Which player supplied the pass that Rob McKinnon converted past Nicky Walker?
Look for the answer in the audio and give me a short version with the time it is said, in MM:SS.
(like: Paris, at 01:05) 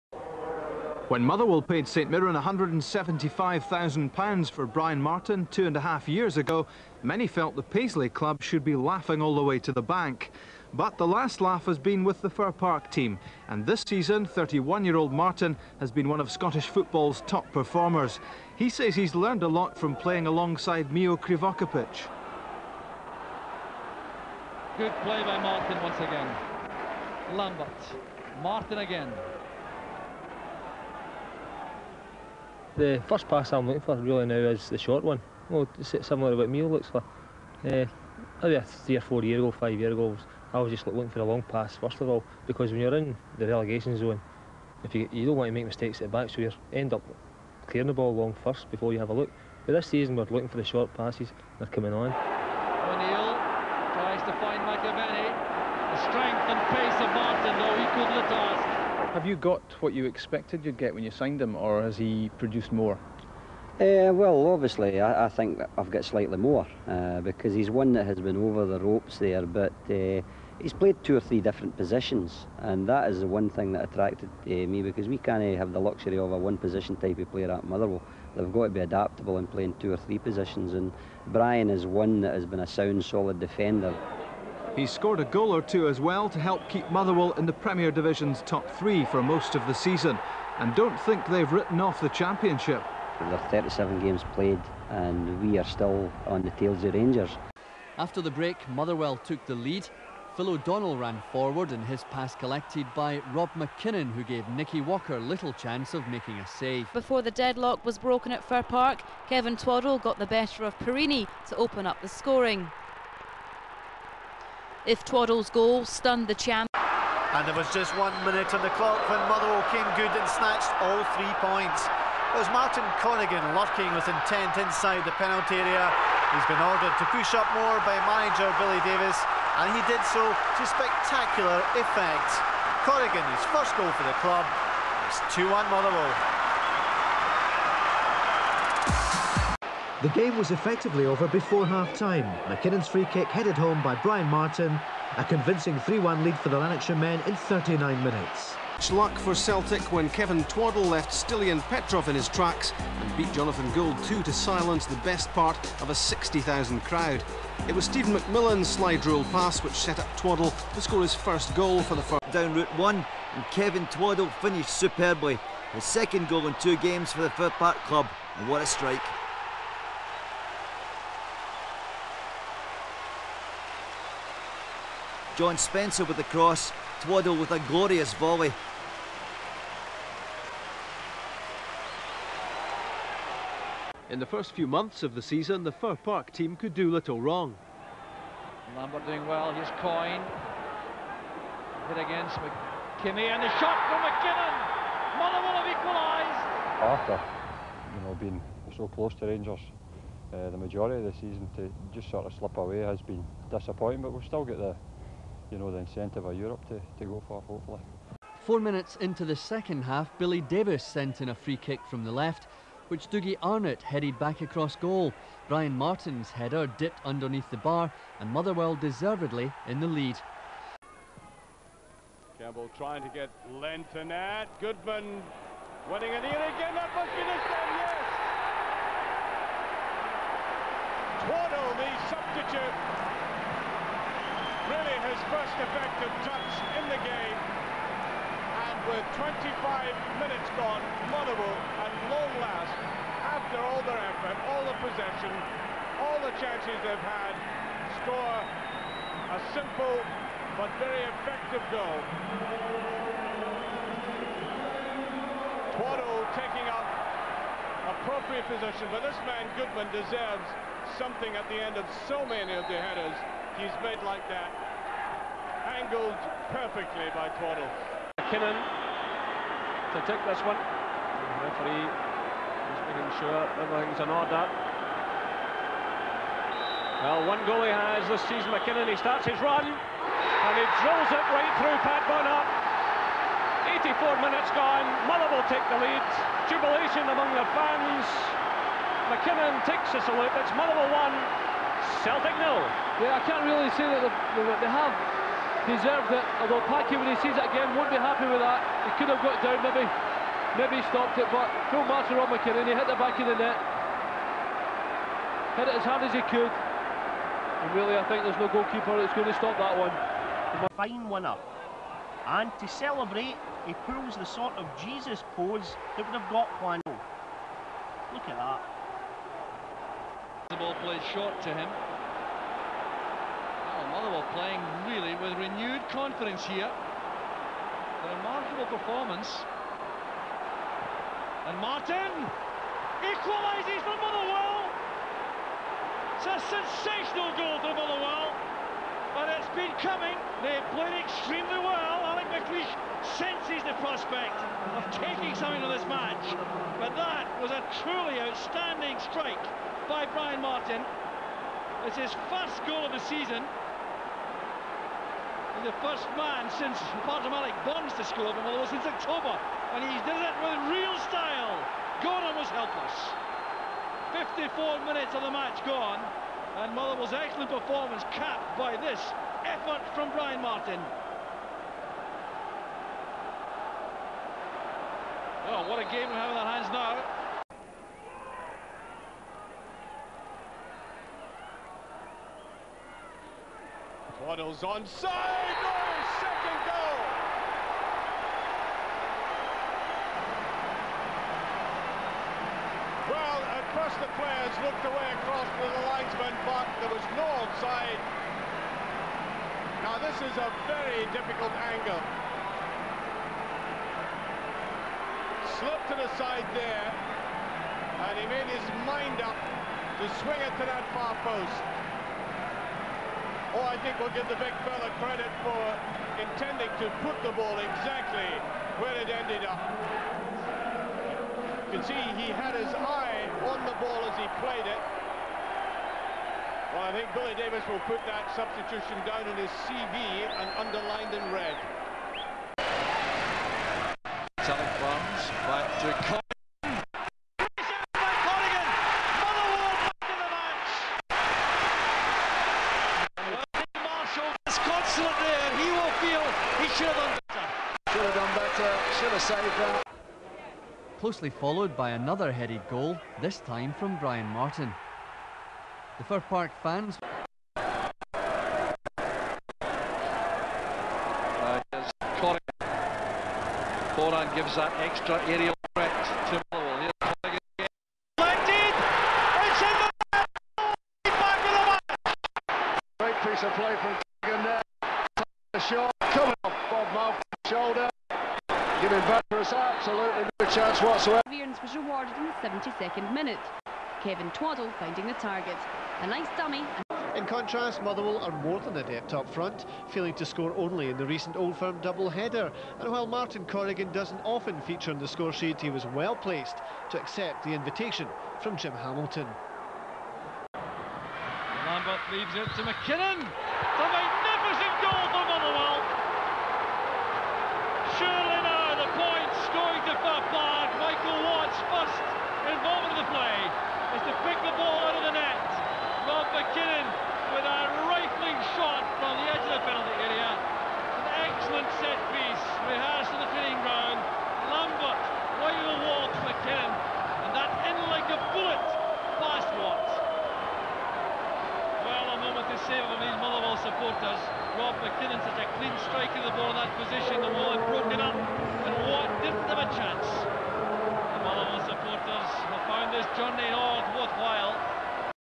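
Phil O'Donnell, at 01:40.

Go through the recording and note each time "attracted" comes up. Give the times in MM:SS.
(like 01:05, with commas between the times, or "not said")
01:13.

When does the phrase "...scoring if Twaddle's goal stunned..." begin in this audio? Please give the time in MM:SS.
01:52.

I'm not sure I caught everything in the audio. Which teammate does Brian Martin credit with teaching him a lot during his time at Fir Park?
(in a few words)
Mio Krivokapic.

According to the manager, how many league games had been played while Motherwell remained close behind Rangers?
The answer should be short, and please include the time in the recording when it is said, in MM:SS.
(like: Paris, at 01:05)
37, at 01:33.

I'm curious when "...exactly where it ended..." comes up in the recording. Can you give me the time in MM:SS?
06:57.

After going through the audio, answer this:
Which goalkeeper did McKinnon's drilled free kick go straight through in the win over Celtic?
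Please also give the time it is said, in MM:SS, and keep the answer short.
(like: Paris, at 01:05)
Pat Bonner, at 04:41.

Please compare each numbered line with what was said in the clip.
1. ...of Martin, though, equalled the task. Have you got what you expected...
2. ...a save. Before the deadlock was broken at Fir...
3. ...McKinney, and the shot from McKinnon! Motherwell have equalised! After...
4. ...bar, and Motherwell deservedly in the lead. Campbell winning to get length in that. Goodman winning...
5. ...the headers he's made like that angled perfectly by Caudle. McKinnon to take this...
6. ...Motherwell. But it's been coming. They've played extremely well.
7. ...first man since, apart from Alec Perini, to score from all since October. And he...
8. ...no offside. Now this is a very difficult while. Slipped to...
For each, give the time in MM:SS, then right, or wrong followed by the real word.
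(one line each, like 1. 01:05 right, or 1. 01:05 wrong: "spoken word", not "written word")
1. 00:56 right
2. 01:46 right
3. 03:12 right
4. 03:37 wrong: "trying", not "winning"
5. 04:22 right
6. 05:37 right
7. 05:55 wrong: "Bonds", not "Perini"
8. 06:37 wrong: "angle", not "while".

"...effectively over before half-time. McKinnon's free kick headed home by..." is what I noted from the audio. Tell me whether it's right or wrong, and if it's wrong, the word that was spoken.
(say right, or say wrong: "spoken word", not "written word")
right.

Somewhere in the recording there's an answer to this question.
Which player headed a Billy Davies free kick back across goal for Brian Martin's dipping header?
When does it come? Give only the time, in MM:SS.
03:33.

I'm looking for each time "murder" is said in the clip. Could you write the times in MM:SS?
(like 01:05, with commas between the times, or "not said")
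not said.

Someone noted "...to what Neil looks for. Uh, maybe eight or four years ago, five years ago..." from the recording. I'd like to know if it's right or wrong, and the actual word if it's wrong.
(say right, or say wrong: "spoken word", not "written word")
wrong: "three", not "eight".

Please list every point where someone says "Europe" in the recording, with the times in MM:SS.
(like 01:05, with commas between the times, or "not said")
03:26.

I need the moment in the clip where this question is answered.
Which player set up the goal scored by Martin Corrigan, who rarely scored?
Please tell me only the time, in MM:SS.
08:18.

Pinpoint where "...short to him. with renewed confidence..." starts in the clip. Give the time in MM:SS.
05:21.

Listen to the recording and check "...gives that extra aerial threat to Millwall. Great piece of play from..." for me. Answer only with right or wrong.
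right.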